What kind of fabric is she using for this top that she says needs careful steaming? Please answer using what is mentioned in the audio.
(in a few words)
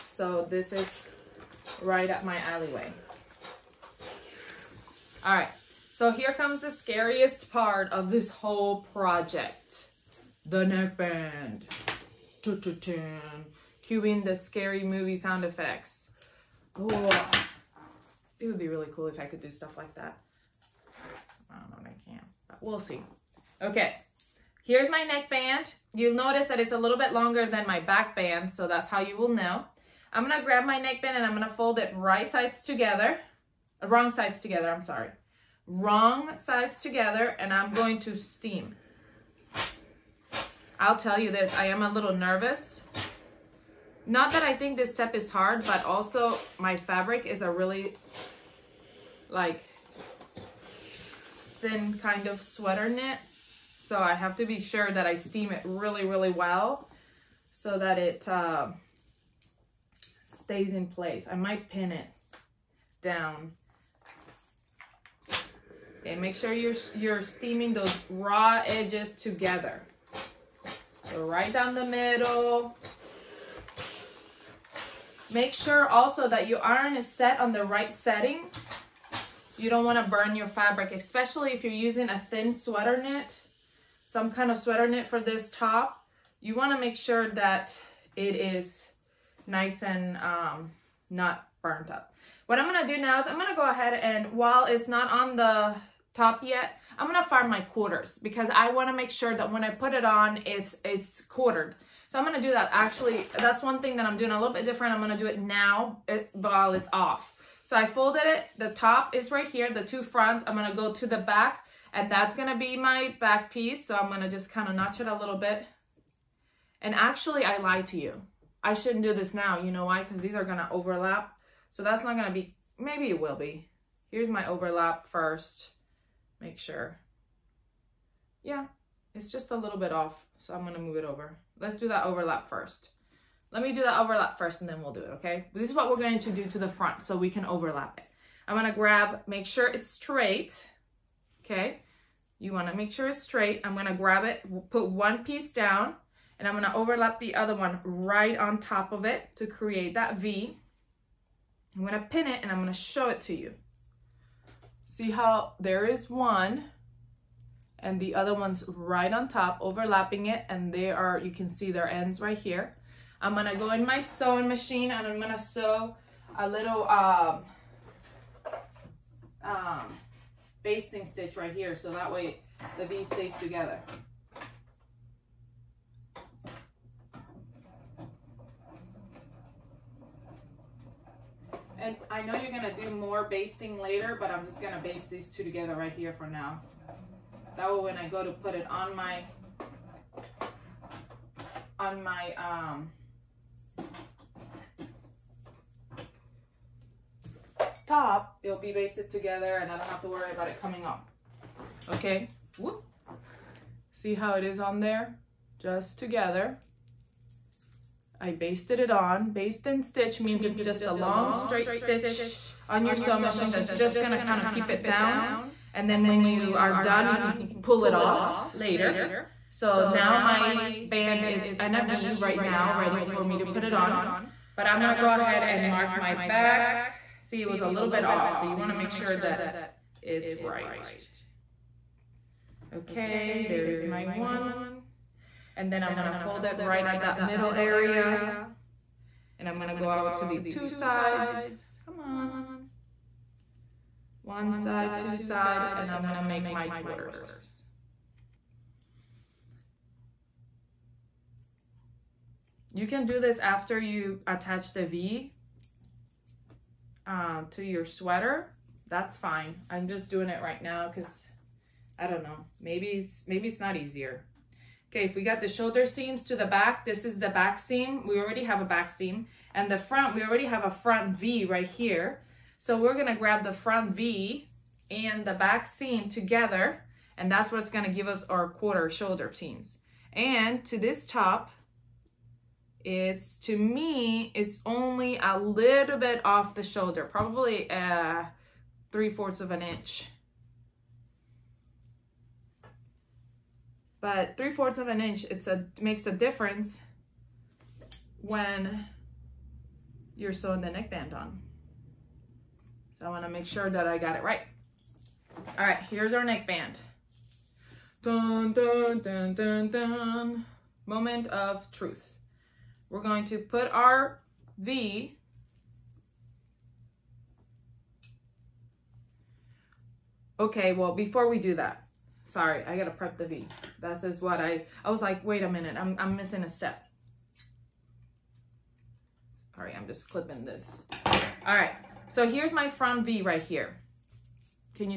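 thin sweater knit.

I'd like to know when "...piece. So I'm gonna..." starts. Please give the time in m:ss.
1:53.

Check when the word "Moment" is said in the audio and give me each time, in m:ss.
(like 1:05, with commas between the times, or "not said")
5:10.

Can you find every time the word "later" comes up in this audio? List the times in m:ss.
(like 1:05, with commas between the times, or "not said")
3:03, 3:38.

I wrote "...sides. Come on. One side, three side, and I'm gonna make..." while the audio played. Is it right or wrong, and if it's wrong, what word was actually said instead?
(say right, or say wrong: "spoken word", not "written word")
wrong: "two", not "three".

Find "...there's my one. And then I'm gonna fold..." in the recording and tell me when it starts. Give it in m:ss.
3:53.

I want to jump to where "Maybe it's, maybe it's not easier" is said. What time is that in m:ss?
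4:22.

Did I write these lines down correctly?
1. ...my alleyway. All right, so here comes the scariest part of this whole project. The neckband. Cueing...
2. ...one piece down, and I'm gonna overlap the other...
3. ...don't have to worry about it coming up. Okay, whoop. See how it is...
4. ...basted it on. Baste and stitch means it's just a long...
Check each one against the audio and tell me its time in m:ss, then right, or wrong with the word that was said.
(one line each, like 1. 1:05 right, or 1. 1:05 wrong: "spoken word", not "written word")
1. 0:02 right
2. 2:24 right
3. 3:19 right
4. 3:28 right.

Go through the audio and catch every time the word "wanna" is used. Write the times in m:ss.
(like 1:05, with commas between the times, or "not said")
2:22, 3:48, 5:03.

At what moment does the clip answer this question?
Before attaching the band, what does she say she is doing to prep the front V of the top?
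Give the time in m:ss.
5:30.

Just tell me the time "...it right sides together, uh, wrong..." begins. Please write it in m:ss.
0:31.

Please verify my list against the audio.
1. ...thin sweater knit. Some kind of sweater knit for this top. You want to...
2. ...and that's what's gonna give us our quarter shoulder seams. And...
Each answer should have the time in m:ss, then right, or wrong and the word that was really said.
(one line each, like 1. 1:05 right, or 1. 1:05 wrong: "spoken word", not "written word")
1. 1:22 right
2. 4:37 right.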